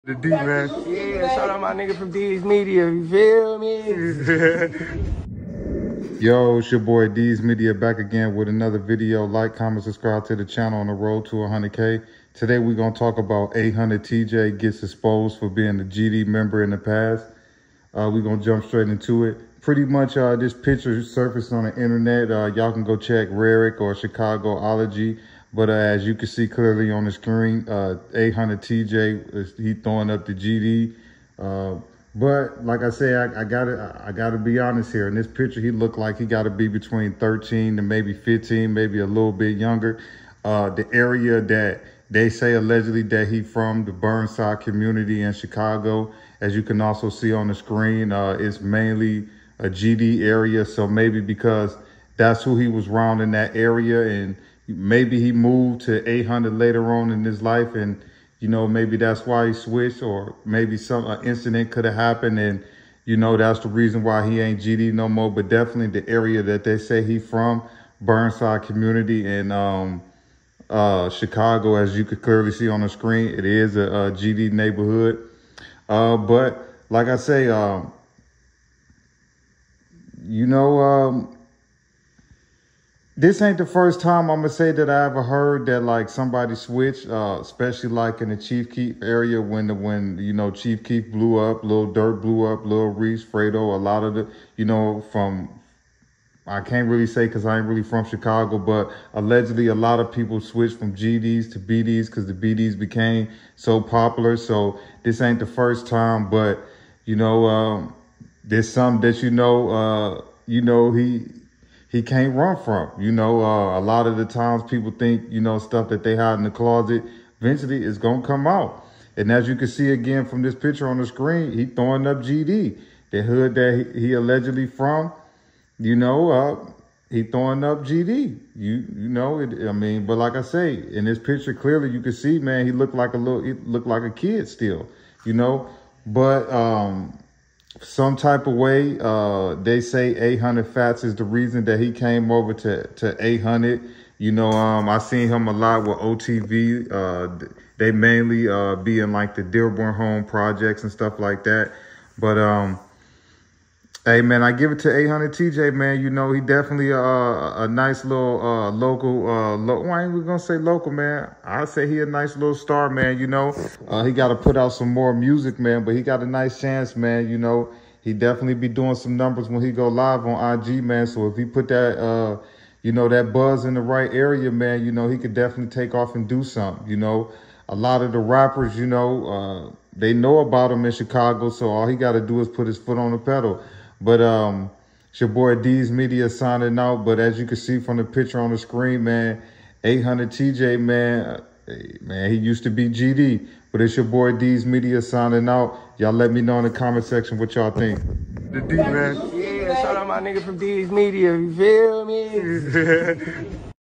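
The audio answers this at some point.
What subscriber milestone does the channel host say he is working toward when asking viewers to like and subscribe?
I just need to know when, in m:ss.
0:11.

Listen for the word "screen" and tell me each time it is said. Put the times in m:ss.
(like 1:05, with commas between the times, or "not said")
0:27, 0:47, 1:12, 2:01, 3:08.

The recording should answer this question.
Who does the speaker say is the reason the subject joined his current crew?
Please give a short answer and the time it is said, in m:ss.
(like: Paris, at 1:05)
800 Fatz, at 2:20.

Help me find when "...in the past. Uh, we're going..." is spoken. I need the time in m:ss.
0:16.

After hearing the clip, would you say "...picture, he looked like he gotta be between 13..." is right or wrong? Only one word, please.
right.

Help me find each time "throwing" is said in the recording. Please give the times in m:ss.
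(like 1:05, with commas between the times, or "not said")
0:29, 2:01, 2:07.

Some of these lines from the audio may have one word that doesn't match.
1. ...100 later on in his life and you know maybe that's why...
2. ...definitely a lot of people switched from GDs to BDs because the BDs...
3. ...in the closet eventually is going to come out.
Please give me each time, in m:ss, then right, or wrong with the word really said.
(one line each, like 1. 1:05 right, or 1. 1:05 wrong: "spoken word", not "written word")
1. 0:56 wrong: "800", not "100"
2. 1:39 wrong: "allegedly", not "definitely"
3. 1:56 right.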